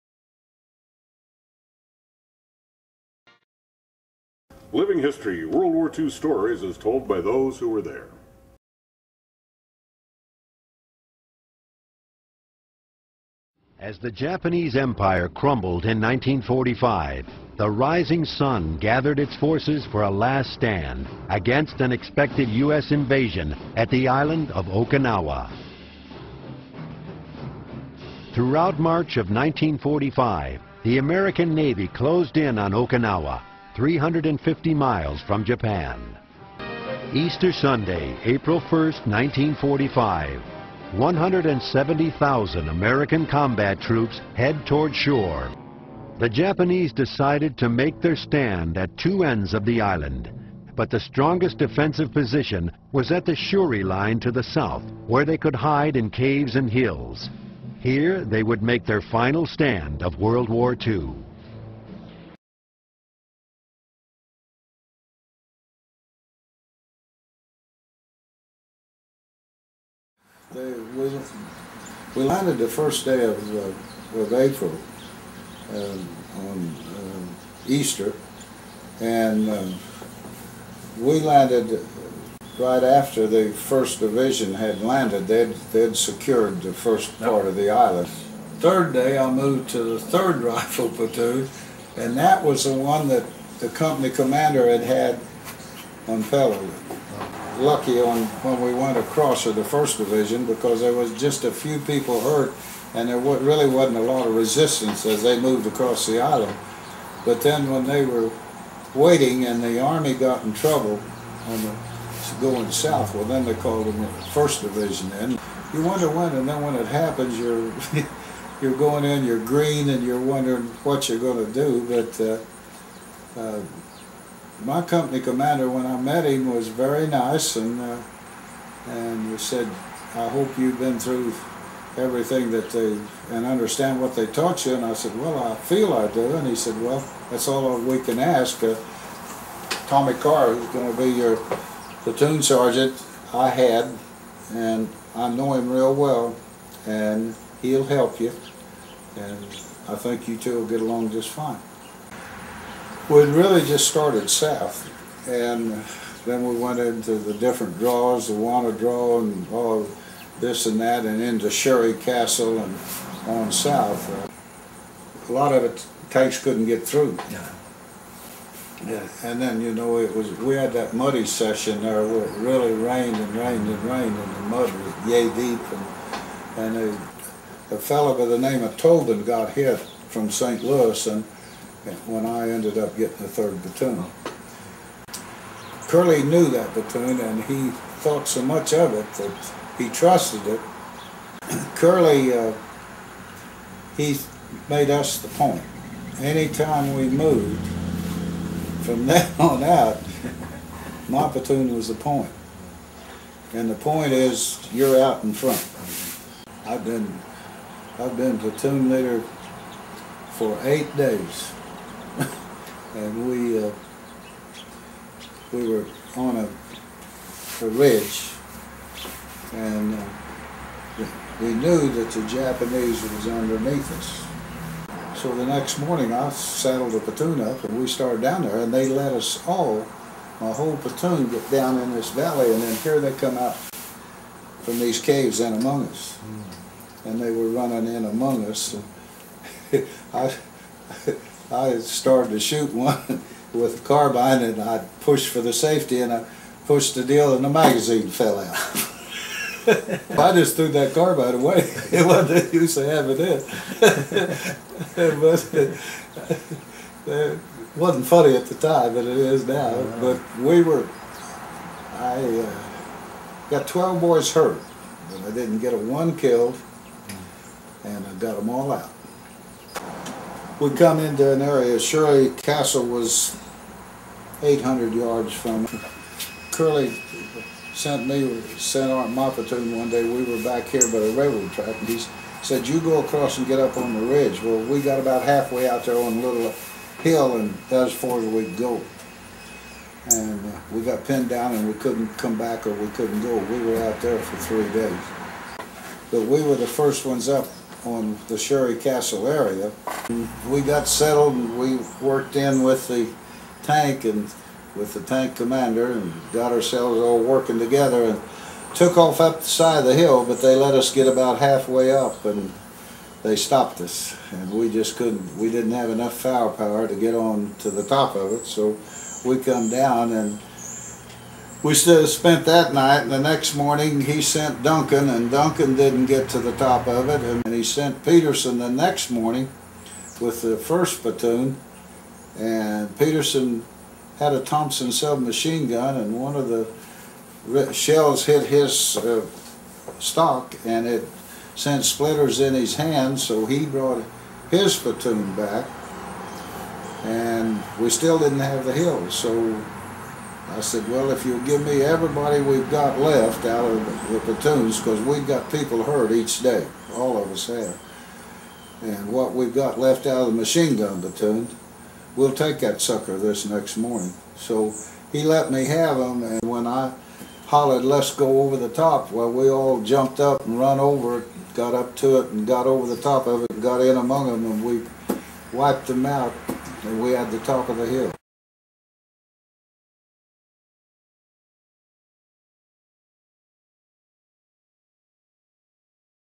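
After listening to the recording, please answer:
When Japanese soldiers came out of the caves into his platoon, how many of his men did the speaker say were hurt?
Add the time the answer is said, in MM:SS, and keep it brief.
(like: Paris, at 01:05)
12, at 04:23.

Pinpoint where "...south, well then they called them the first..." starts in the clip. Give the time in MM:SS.
01:52.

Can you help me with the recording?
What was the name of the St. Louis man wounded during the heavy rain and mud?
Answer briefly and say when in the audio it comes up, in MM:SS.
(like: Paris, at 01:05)
Tobin, at 02:58.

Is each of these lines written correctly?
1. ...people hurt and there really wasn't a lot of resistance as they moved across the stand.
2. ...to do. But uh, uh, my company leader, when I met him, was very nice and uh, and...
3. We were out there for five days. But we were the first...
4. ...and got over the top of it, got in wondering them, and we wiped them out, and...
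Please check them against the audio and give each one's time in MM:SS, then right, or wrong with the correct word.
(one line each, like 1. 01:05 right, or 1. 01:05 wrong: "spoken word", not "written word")
1. 01:41 wrong: "island", not "stand"
2. 02:01 wrong: "commander", not "leader"
3. 04:53 wrong: "three", not "five"
4. 06:12 wrong: "among", not "wondering".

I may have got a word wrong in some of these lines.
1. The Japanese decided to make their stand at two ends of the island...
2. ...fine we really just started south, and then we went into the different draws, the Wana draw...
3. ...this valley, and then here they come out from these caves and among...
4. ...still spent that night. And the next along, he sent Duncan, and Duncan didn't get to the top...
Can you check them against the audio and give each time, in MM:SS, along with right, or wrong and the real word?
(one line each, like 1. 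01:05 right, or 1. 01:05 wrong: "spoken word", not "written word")
1. 00:46 right
2. 02:31 right
3. 03:51 right
4. 05:21 wrong: "morning", not "along".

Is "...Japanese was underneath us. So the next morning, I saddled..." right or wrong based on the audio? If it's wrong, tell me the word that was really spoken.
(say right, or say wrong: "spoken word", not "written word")
right.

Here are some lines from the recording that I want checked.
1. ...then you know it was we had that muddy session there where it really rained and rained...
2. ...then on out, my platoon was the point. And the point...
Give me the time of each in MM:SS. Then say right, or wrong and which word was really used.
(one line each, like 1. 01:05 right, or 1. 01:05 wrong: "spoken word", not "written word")
1. 02:49 right
2. 03:19 right.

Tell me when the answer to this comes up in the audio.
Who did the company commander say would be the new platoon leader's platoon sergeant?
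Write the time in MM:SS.
02:19.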